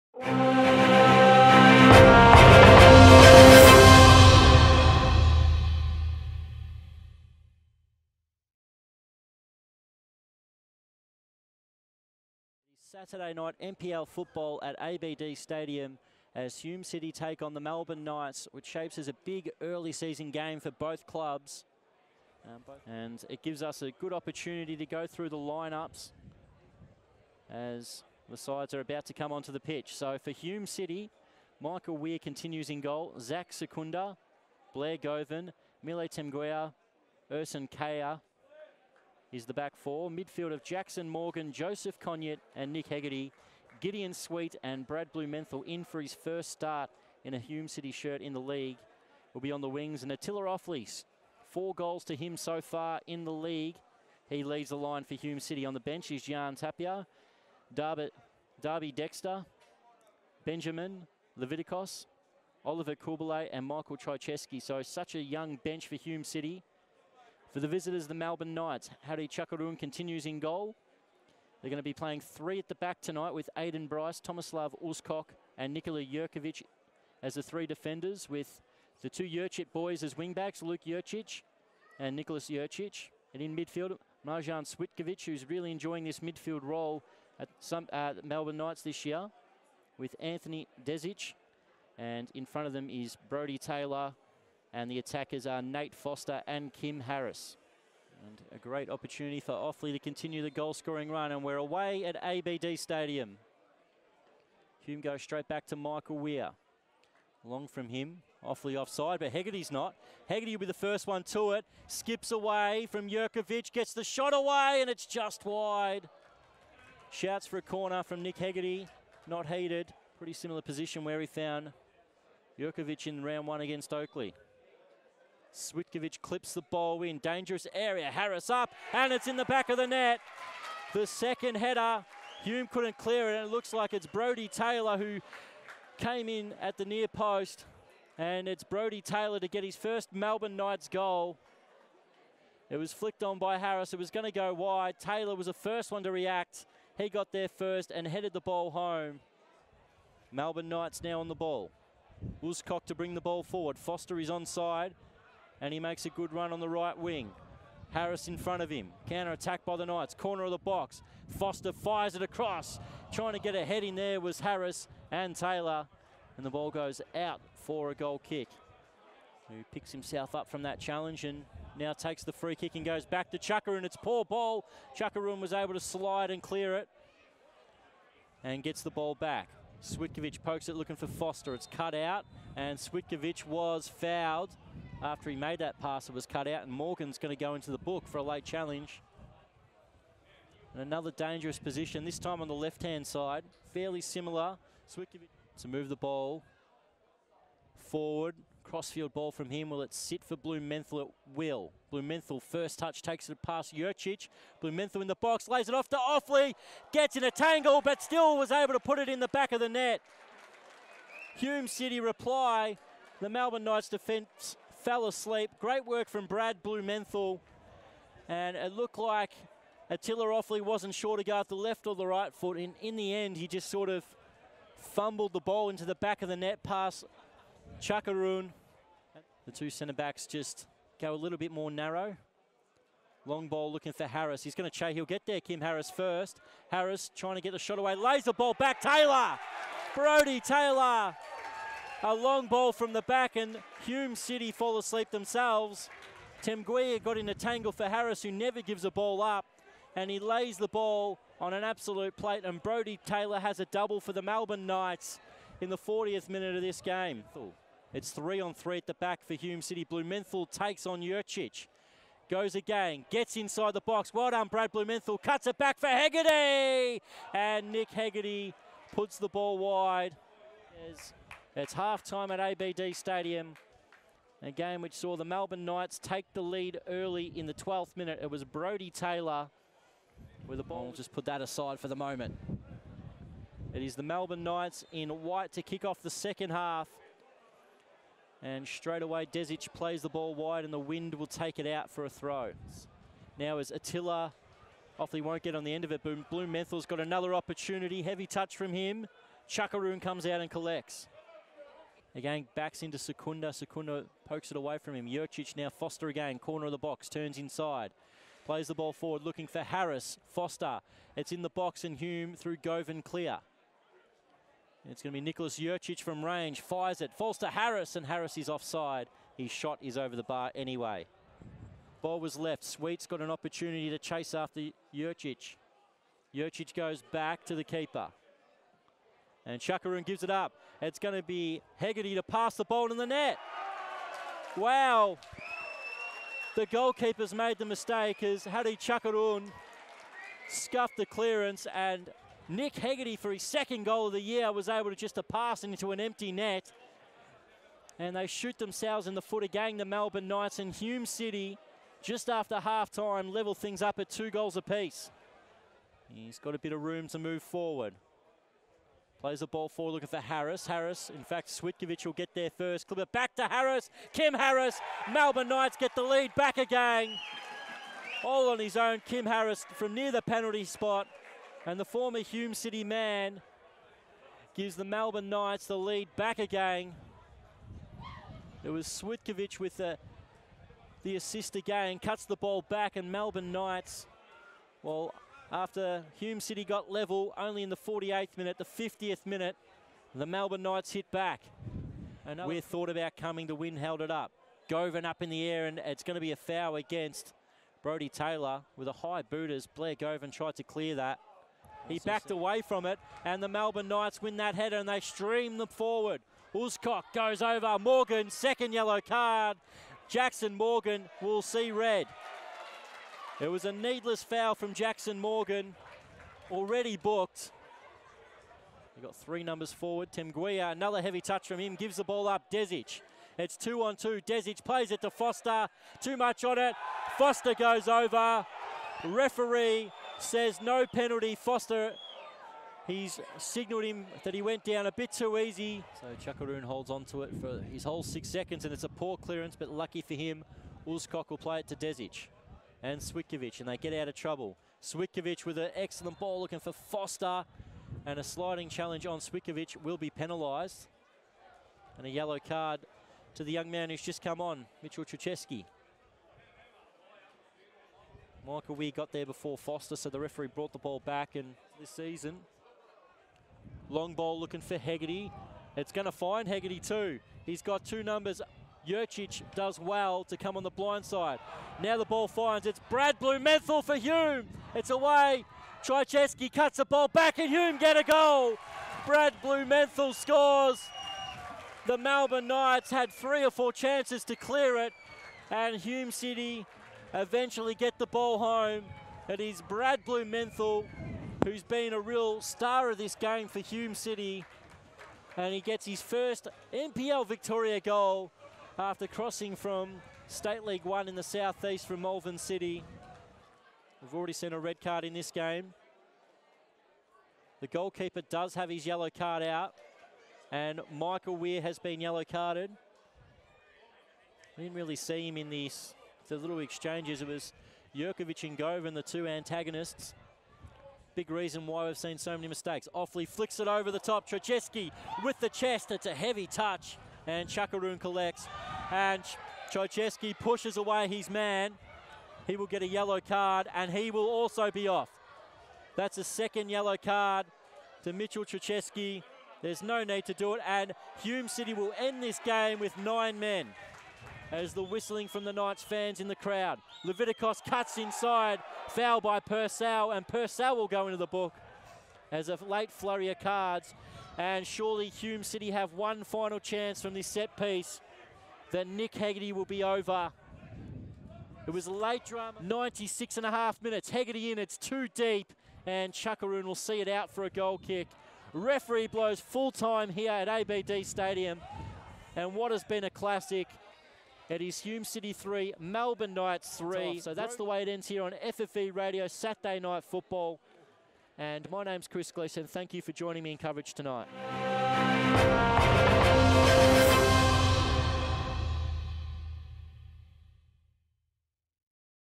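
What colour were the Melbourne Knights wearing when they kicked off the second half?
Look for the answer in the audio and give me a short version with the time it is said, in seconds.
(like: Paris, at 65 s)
White, at 285 s.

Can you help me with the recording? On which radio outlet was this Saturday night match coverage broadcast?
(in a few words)
FFE Radio.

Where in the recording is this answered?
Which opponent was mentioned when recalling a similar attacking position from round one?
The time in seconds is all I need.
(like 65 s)
123 s.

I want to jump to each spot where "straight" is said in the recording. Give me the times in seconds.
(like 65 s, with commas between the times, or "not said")
105 s, 288 s.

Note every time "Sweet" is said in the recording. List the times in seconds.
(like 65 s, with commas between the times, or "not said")
44 s, 322 s.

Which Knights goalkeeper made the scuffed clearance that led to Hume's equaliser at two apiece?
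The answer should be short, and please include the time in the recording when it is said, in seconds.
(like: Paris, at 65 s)
Hadi Chakaroon, at 338 s.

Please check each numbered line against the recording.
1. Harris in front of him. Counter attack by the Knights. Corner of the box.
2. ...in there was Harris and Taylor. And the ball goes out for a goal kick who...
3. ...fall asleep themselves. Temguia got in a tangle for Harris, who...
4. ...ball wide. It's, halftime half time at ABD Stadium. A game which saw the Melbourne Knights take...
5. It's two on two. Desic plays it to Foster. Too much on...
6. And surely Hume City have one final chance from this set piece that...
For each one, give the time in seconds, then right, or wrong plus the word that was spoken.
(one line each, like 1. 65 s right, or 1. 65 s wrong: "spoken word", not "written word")
1. 157 s right
2. 163 s right
3. 244 s right
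4. 269 s right
5. 423 s right
6. 554 s right.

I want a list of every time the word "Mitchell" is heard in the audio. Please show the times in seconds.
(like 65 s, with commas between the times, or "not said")
454 s, 538 s.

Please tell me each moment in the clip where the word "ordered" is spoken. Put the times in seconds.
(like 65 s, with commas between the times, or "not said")
not said.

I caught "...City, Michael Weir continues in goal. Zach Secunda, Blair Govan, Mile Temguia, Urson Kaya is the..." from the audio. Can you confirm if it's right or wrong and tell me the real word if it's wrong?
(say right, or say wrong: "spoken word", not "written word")
right.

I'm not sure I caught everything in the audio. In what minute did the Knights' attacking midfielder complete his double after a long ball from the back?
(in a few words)
40th.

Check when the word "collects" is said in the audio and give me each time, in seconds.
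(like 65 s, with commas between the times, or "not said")
300 s, 527 s.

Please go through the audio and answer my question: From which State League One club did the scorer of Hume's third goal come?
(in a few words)
Malvern City.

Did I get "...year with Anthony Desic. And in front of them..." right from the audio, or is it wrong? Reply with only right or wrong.
right.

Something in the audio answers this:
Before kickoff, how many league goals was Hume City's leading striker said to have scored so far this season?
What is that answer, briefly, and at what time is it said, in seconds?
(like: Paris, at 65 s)
4, at 51 s.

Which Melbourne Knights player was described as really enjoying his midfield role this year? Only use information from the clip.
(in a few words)
Marjan Switkovic.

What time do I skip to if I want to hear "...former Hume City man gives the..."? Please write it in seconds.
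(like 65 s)
371 s.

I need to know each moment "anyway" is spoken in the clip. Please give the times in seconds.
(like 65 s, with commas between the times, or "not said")
320 s.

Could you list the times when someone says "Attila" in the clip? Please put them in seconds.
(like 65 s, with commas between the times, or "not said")
50 s, 219 s, 293 s.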